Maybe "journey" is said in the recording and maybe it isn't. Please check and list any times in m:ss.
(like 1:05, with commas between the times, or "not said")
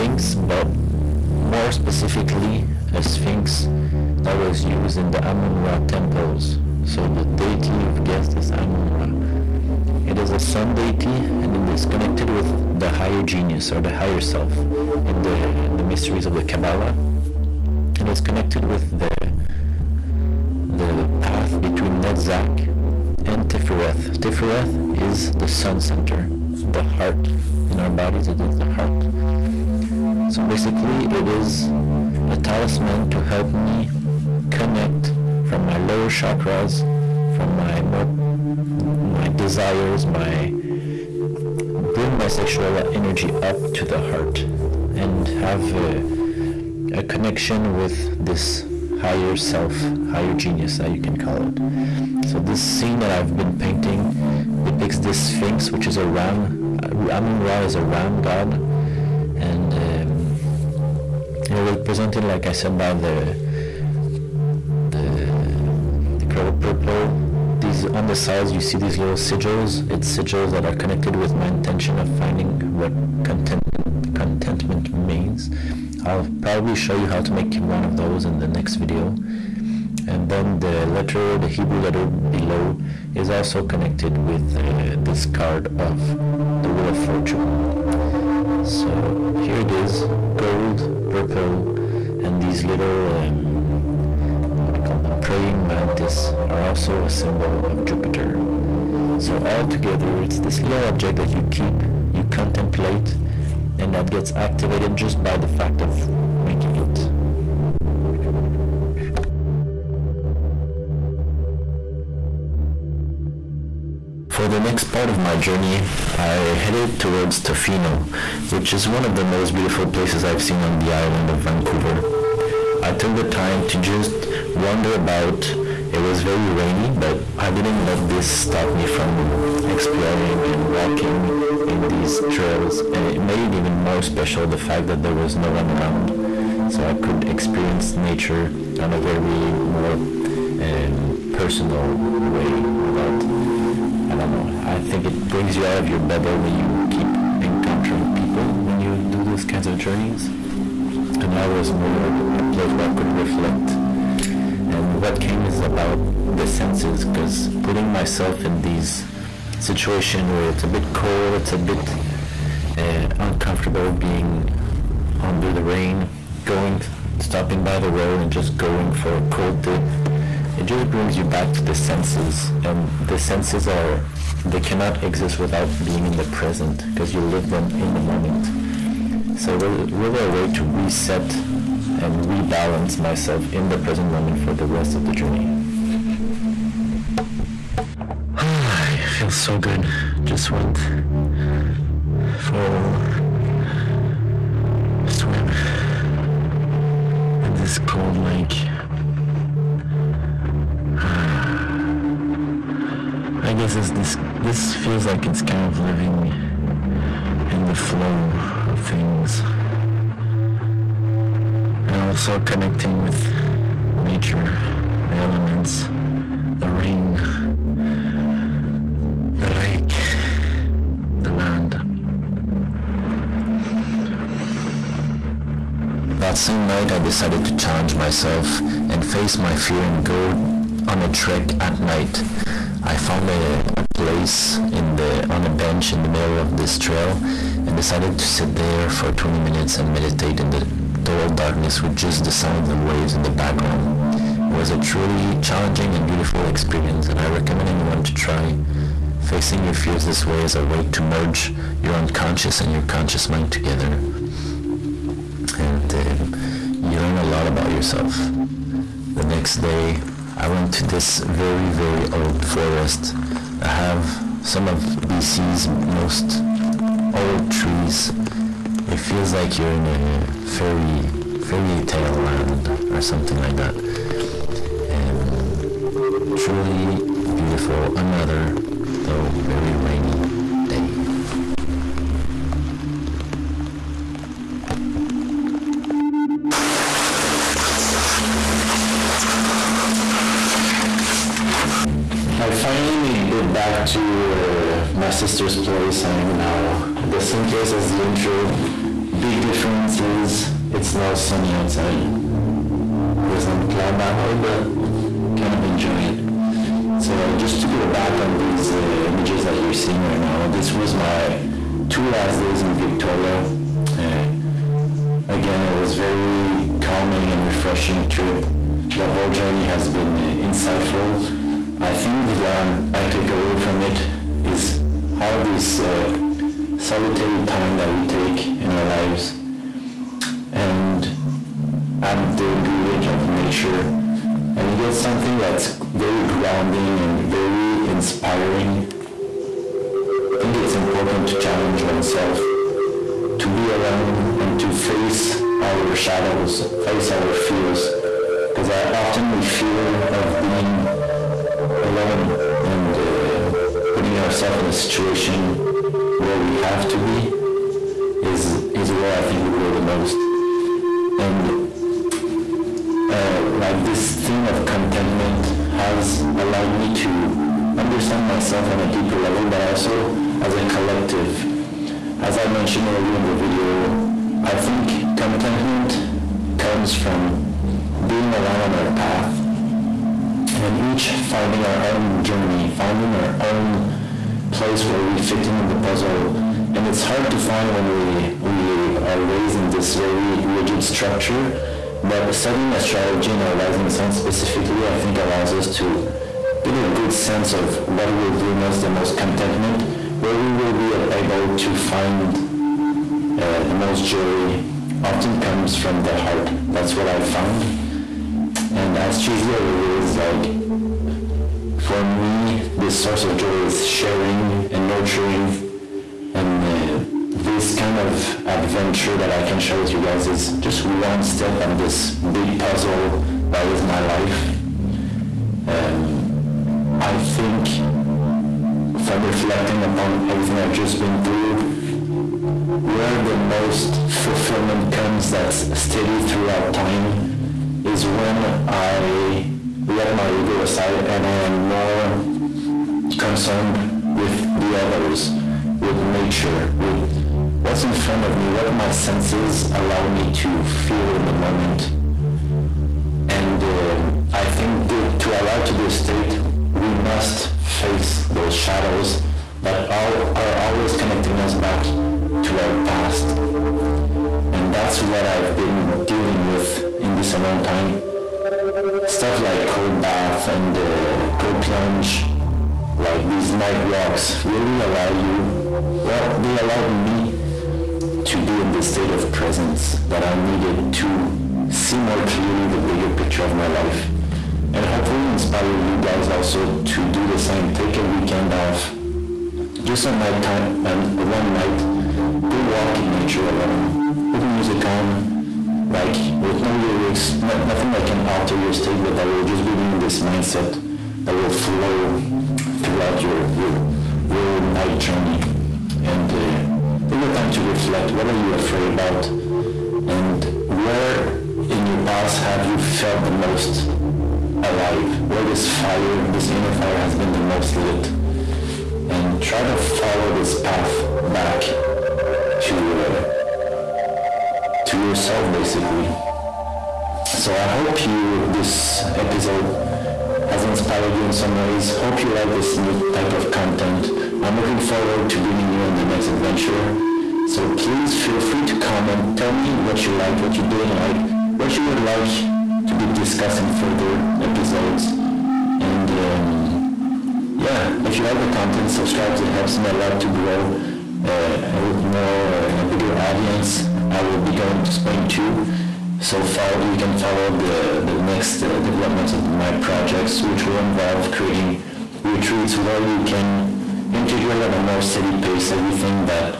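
1:55, 2:29, 3:05, 5:19, 6:22, 8:24.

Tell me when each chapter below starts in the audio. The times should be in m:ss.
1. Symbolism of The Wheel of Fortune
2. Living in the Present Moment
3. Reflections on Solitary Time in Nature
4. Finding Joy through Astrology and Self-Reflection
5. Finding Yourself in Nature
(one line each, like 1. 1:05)
1. 1:17
2. 2:50
3. 4:39
4. 6:25
5. 8:07.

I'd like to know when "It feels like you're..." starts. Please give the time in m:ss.
4:28.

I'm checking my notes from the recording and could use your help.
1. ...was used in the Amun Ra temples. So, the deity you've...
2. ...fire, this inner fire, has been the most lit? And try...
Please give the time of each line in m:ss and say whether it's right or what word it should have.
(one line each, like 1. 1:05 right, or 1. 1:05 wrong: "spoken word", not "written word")
1. 0:04 right
2. 8:35 right.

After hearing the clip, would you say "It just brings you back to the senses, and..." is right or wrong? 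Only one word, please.
right.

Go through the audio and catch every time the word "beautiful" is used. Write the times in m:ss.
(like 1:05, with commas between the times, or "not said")
1:59, 4:06, 4:37.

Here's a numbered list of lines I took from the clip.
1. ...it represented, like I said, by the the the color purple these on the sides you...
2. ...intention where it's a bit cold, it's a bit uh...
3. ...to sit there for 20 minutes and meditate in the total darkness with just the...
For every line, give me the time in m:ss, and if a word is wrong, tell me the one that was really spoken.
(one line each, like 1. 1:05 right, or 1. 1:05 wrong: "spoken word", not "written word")
1. 1:01 right
2. 2:39 wrong: "situation", not "intention"
3. 3:58 right.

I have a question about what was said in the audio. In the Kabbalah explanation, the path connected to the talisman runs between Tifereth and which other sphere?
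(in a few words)
Netzach.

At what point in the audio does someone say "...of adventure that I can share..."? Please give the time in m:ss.
6:57.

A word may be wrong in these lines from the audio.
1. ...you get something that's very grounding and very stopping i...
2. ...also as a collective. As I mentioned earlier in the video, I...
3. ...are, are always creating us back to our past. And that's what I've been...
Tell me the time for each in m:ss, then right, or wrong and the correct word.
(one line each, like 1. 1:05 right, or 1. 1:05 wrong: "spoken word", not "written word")
1. 5:34 wrong: "inspiring", not "stopping"
2. 6:09 right
3. 7:39 wrong: "connecting", not "creating".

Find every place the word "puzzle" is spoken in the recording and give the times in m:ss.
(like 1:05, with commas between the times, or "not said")
6:25, 7:02.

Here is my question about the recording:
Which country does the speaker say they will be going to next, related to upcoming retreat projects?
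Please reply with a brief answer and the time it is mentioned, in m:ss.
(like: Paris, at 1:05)
Spain, at 9:14.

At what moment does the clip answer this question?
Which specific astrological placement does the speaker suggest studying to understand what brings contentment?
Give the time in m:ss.
6:33.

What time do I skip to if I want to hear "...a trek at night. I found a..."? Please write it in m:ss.
3:51.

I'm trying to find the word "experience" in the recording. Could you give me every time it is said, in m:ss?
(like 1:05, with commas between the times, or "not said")
2:17, 4:06.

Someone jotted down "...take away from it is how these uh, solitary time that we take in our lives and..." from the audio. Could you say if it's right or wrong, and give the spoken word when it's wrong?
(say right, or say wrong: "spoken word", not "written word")
right.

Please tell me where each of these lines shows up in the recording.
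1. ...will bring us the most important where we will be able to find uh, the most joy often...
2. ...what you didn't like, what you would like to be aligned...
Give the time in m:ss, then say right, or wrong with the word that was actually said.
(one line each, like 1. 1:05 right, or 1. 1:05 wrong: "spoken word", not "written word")
1. 6:38 wrong: "contentment", not "important"
2. 9:00 wrong: "discussed", not "aligned".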